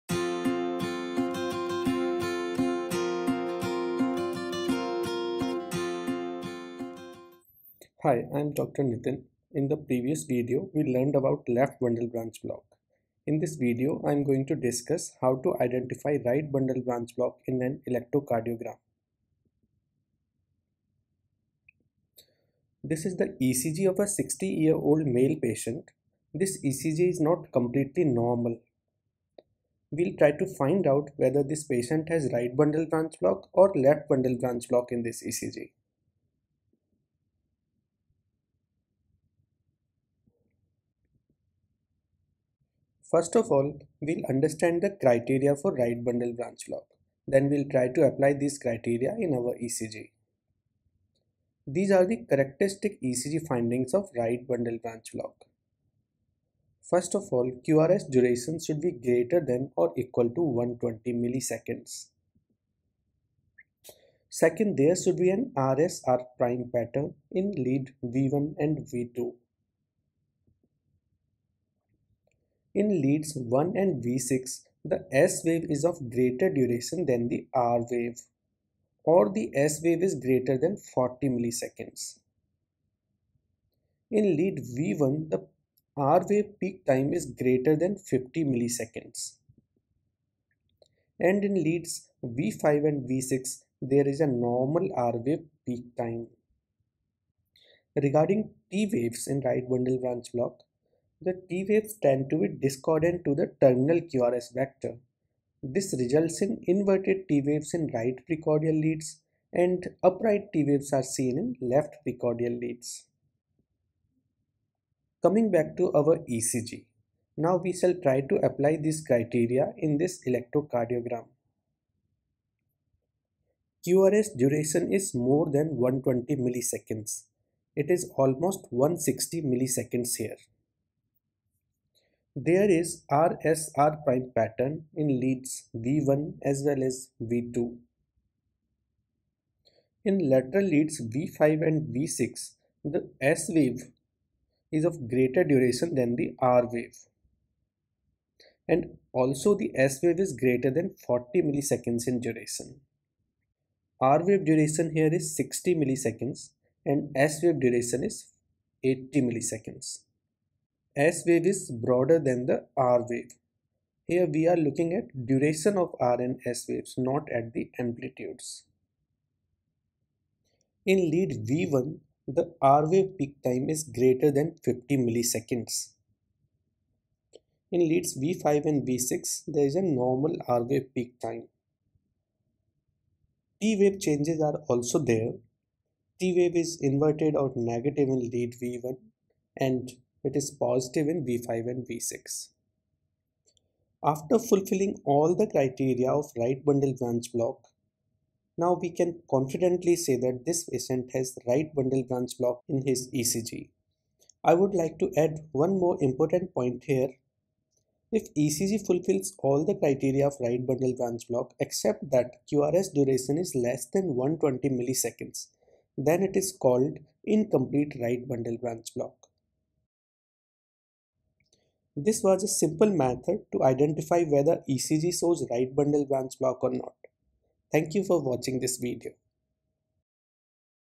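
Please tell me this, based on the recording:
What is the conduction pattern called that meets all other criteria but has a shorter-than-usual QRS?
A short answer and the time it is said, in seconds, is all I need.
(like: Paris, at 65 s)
incomplete right bundle branch block, at 217 s.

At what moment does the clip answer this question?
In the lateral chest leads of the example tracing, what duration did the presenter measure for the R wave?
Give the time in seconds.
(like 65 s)
155 s.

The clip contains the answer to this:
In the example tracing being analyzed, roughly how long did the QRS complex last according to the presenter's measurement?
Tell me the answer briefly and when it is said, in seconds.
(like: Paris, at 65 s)
160 milliseconds, at 128 s.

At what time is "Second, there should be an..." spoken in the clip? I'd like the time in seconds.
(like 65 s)
64 s.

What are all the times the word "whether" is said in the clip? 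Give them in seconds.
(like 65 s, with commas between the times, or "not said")
31 s, 224 s.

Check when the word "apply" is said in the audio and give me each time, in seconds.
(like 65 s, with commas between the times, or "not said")
48 s, 118 s.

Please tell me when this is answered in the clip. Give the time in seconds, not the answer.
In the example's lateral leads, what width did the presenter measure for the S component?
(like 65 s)
158 s.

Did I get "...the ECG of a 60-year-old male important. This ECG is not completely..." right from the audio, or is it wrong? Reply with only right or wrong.
wrong.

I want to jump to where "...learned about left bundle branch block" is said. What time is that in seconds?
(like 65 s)
10 s.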